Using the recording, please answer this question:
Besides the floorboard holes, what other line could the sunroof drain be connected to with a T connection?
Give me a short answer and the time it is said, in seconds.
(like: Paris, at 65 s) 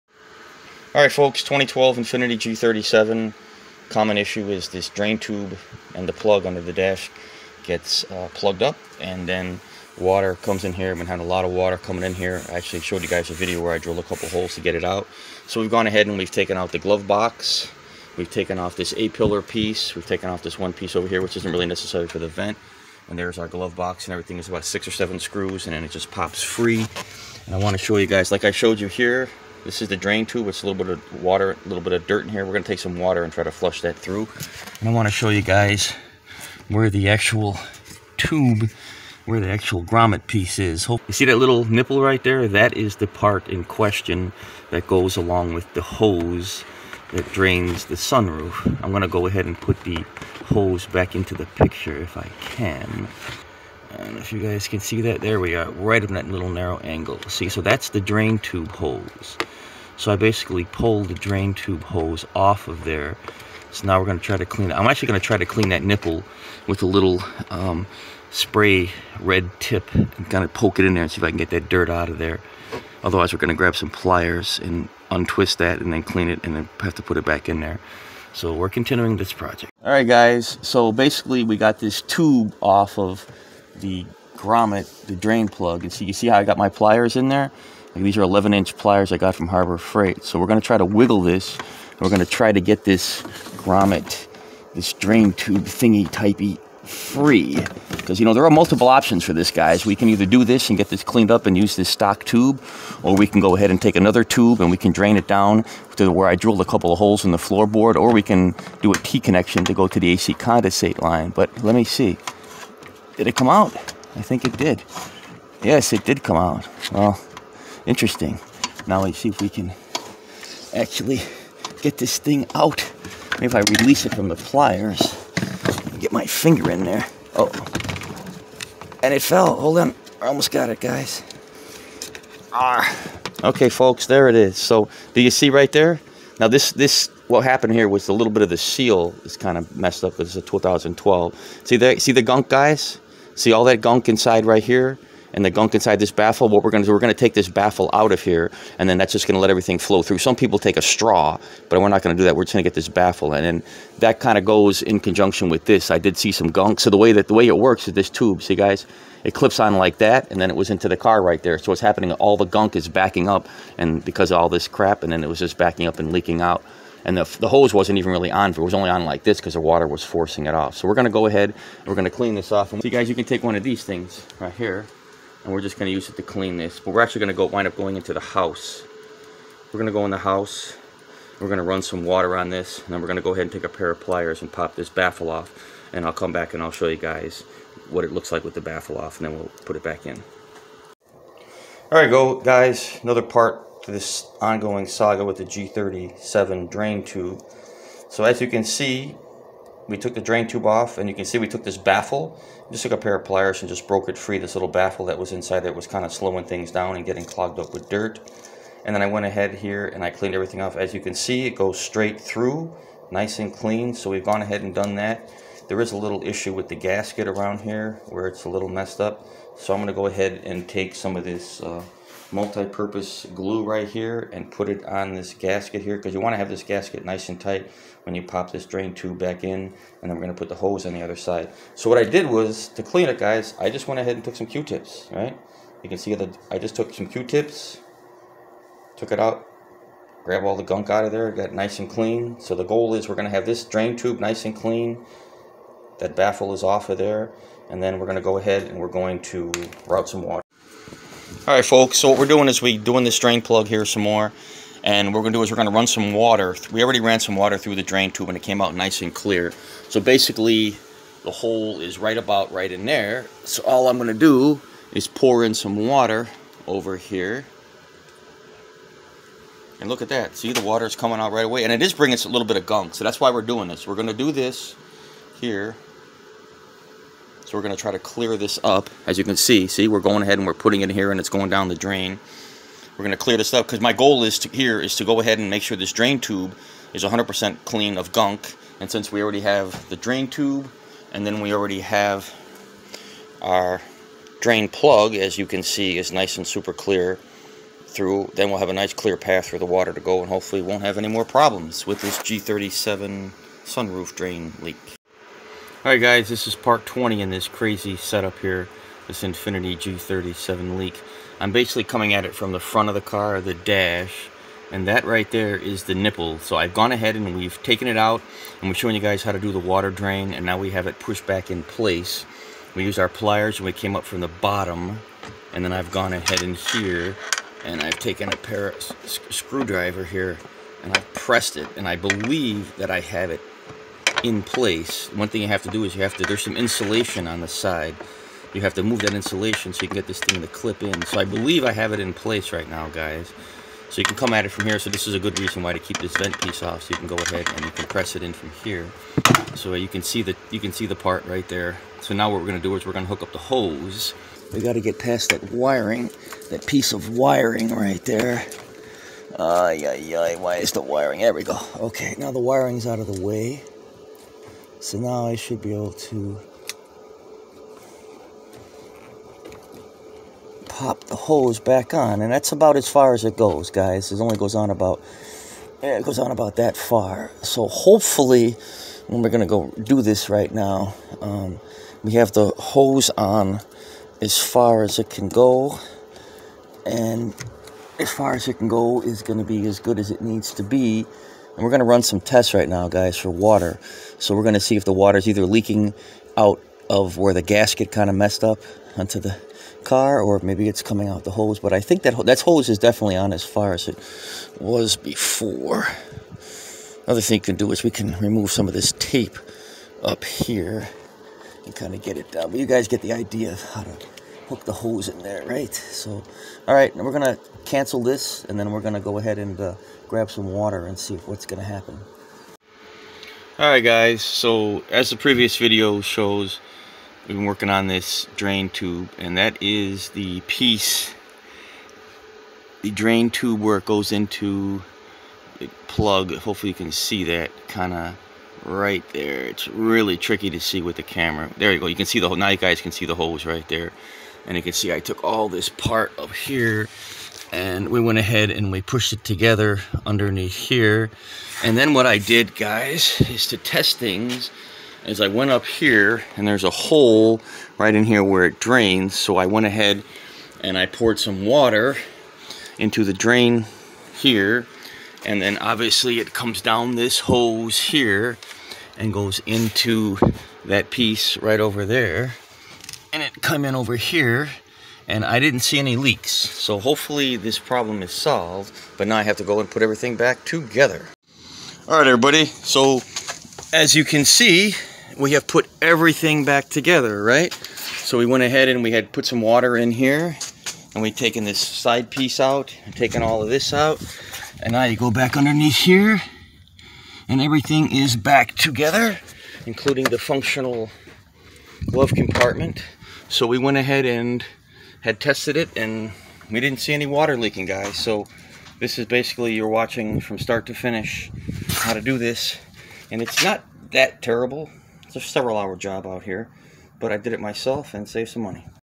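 AC condensate line, at 110 s.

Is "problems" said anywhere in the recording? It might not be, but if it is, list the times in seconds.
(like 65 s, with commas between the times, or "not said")
301 s, 477 s.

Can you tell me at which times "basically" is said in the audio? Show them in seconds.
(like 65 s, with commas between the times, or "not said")
60 s, 80 s, 259 s, 311 s, 509 s.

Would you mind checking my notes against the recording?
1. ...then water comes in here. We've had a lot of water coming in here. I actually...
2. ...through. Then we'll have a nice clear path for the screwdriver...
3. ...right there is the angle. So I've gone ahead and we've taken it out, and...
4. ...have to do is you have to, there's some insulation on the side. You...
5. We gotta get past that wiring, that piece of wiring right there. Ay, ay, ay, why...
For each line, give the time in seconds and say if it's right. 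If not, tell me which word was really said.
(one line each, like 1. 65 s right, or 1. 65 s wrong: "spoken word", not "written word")
1. 9 s right
2. 297 s wrong: "water", not "screwdriver"
3. 315 s wrong: "nipple", not "angle"
4. 335 s right
5. 354 s right.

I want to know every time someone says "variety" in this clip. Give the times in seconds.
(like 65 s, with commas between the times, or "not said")
not said.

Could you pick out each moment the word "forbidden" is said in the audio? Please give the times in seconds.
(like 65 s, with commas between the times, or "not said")
not said.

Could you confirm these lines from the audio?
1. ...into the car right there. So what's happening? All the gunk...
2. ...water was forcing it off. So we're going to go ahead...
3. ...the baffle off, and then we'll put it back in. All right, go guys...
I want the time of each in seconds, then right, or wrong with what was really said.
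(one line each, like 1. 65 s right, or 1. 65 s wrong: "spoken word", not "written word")
1. 160 s right
2. 169 s right
3. 188 s right.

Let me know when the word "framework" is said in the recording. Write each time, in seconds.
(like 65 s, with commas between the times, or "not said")
not said.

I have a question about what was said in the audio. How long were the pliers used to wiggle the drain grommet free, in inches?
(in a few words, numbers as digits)
11 inch.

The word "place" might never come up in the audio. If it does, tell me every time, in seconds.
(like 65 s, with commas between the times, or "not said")
321 s, 334 s, 342 s.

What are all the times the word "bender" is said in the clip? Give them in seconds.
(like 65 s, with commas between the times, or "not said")
not said.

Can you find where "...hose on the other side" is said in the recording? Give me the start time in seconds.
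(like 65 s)
230 s.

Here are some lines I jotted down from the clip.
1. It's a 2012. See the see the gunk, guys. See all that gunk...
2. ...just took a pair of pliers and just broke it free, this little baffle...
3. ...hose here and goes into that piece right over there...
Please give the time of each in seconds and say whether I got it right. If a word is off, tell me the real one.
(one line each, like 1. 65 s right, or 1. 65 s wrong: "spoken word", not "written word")
1. 140 s right
2. 202 s right
3. 467 s right.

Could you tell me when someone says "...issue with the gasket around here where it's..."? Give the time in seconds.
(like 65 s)
216 s.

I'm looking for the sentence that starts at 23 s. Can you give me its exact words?
And there's our glove box and everything.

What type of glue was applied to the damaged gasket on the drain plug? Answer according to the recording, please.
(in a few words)
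multi-purpose glue.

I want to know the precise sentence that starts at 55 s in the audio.
There we are, right in that little narrow angle.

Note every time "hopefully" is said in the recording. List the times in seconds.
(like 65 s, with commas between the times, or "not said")
300 s, 377 s, 436 s, 476 s.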